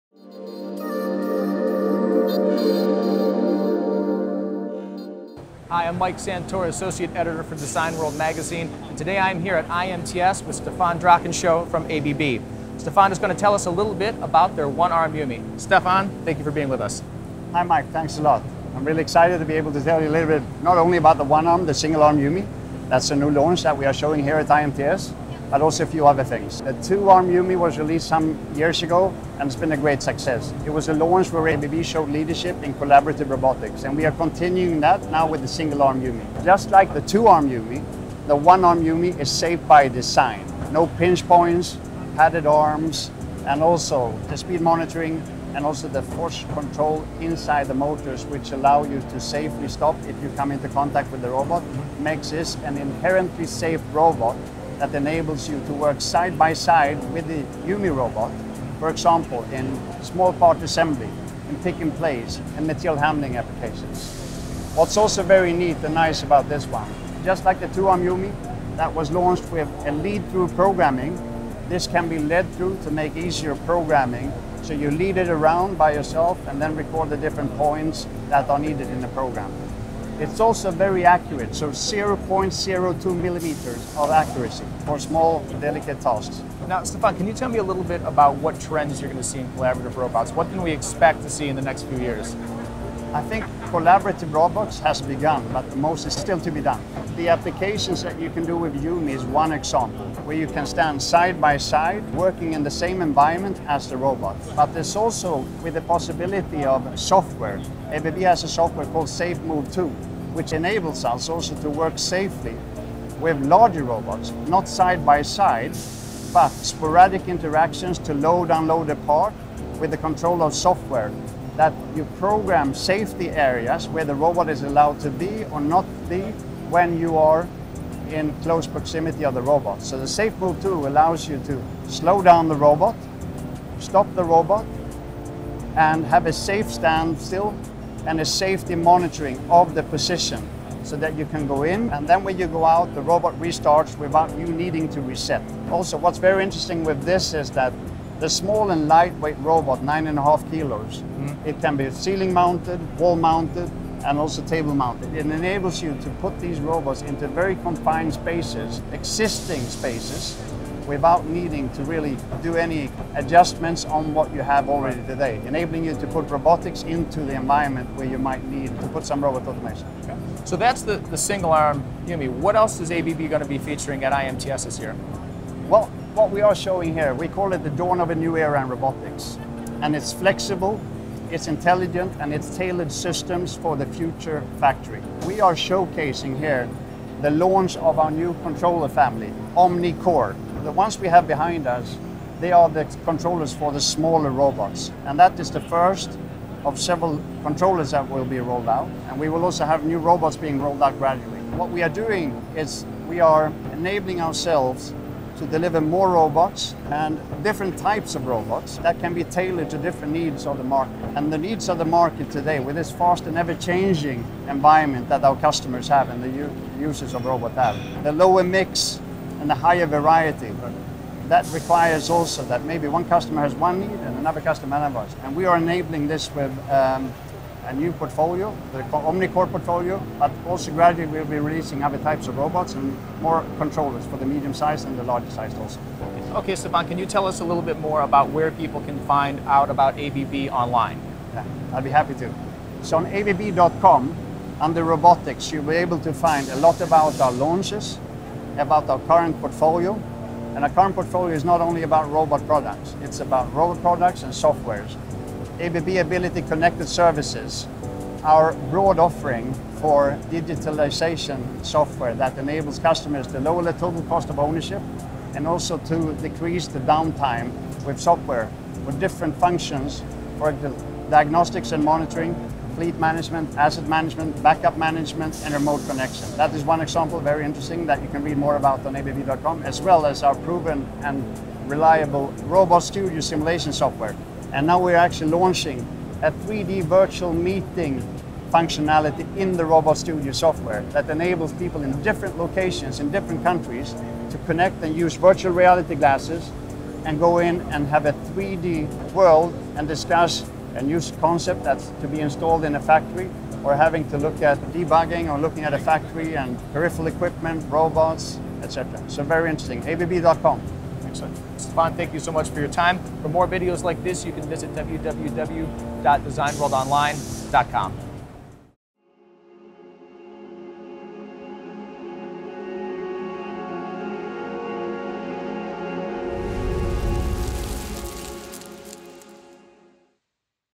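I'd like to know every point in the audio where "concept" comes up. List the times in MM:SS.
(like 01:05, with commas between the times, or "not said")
05:01.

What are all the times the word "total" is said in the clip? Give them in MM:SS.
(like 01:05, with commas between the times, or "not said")
04:23.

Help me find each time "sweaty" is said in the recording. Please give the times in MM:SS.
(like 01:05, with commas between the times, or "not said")
not said.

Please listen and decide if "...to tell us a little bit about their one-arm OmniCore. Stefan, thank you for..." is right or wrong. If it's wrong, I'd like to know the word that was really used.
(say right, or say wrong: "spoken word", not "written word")
wrong: "Yumi", not "OmniCore".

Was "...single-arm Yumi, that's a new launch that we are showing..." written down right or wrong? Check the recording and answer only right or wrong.
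right.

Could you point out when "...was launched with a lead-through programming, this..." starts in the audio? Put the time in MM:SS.
01:08.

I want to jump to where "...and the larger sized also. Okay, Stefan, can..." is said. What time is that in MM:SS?
03:54.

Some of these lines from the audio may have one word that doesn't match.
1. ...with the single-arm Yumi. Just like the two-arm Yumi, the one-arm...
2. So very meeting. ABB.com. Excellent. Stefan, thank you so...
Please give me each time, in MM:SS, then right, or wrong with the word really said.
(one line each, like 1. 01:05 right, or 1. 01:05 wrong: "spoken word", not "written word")
1. 00:35 right
2. 05:09 wrong: "interesting", not "meeting".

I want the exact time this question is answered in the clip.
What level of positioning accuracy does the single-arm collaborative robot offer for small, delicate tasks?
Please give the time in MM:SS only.
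01:21.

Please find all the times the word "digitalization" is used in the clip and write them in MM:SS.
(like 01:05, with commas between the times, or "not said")
04:20.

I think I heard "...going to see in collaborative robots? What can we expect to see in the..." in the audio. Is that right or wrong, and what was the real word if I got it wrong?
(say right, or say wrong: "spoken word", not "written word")
right.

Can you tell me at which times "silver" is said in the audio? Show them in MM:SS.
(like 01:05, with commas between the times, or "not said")
not said.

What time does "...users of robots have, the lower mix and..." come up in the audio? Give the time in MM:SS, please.
03:36.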